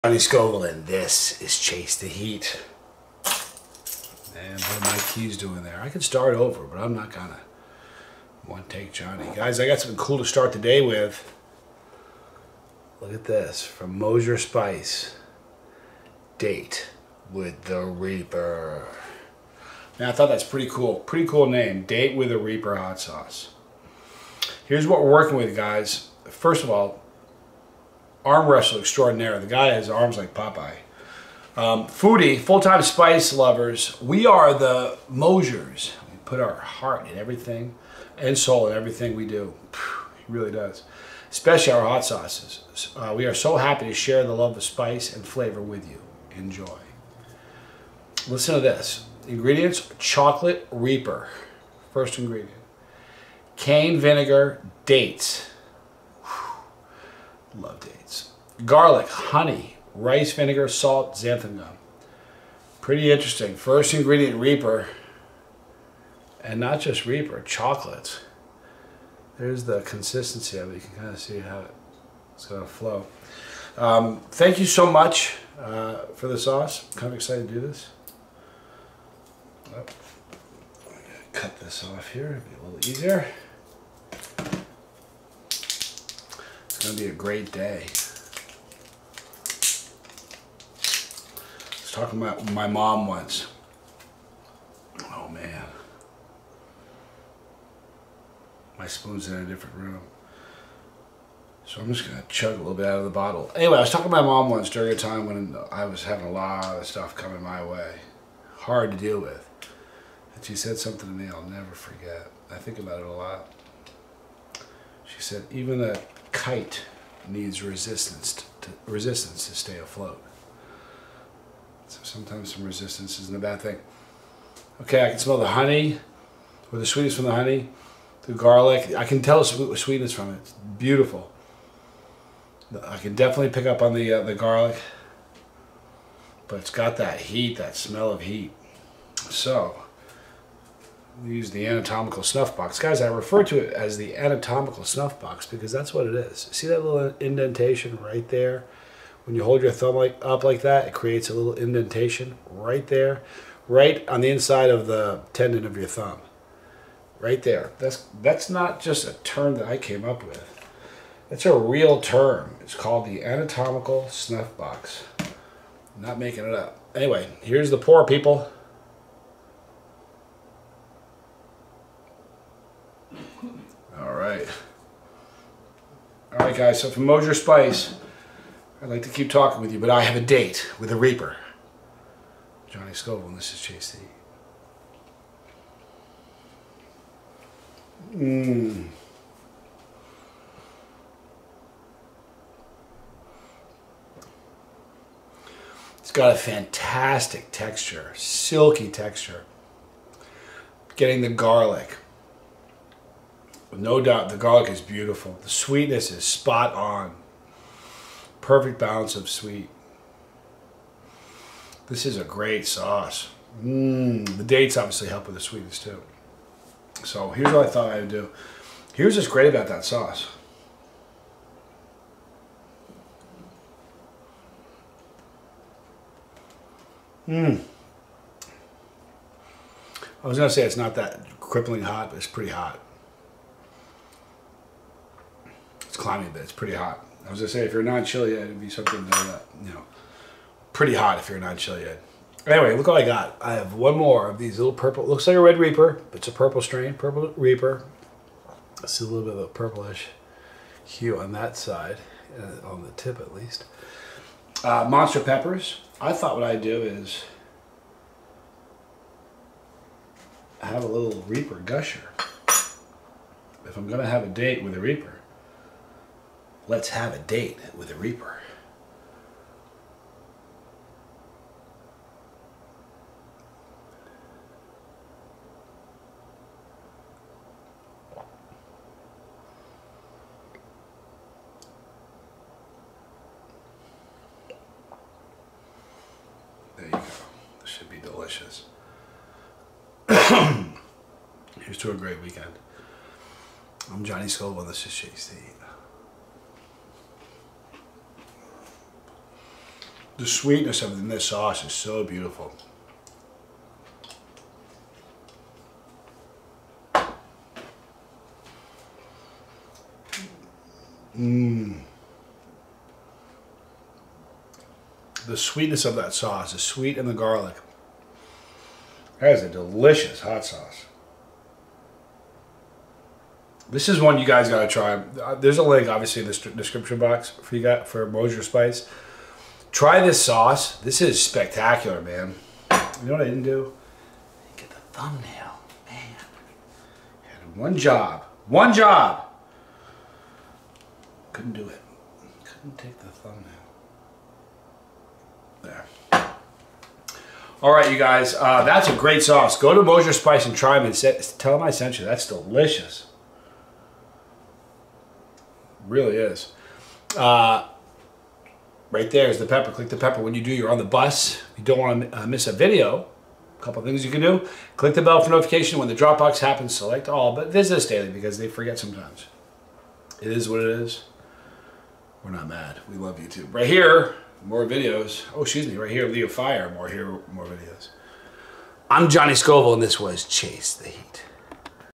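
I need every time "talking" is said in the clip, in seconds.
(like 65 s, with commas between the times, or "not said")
92 s, 103 s, 179 s.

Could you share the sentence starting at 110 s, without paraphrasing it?
And she said something to me I'll never forget.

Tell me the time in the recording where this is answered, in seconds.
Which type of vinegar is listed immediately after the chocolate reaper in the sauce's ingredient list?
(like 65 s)
53 s.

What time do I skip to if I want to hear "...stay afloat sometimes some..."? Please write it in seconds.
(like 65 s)
119 s.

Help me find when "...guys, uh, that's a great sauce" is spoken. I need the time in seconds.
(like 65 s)
347 s.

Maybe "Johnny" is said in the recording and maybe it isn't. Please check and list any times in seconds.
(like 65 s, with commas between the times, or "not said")
0 s, 8 s, 182 s, 294 s, 379 s.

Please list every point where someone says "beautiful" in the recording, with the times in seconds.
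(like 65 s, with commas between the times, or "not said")
130 s, 204 s, 302 s.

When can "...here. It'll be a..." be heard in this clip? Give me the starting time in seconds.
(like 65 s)
82 s.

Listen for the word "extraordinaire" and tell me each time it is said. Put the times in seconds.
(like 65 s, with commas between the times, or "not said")
28 s.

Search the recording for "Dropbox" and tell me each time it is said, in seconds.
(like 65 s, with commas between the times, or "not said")
365 s.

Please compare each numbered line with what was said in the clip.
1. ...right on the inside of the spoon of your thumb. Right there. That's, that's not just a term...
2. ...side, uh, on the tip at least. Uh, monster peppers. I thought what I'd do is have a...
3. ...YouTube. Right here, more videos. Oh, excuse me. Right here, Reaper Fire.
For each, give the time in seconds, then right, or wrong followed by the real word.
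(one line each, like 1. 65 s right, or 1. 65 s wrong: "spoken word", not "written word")
1. 153 s wrong: "tendon", not "spoon"
2. 251 s right
3. 373 s wrong: "Leo", not "Reaper".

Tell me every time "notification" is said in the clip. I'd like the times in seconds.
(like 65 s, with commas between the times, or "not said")
365 s.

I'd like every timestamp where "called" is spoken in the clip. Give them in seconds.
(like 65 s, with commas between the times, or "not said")
162 s.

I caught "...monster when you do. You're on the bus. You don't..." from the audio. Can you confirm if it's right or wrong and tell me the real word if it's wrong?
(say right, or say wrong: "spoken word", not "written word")
wrong: "pepper", not "monster".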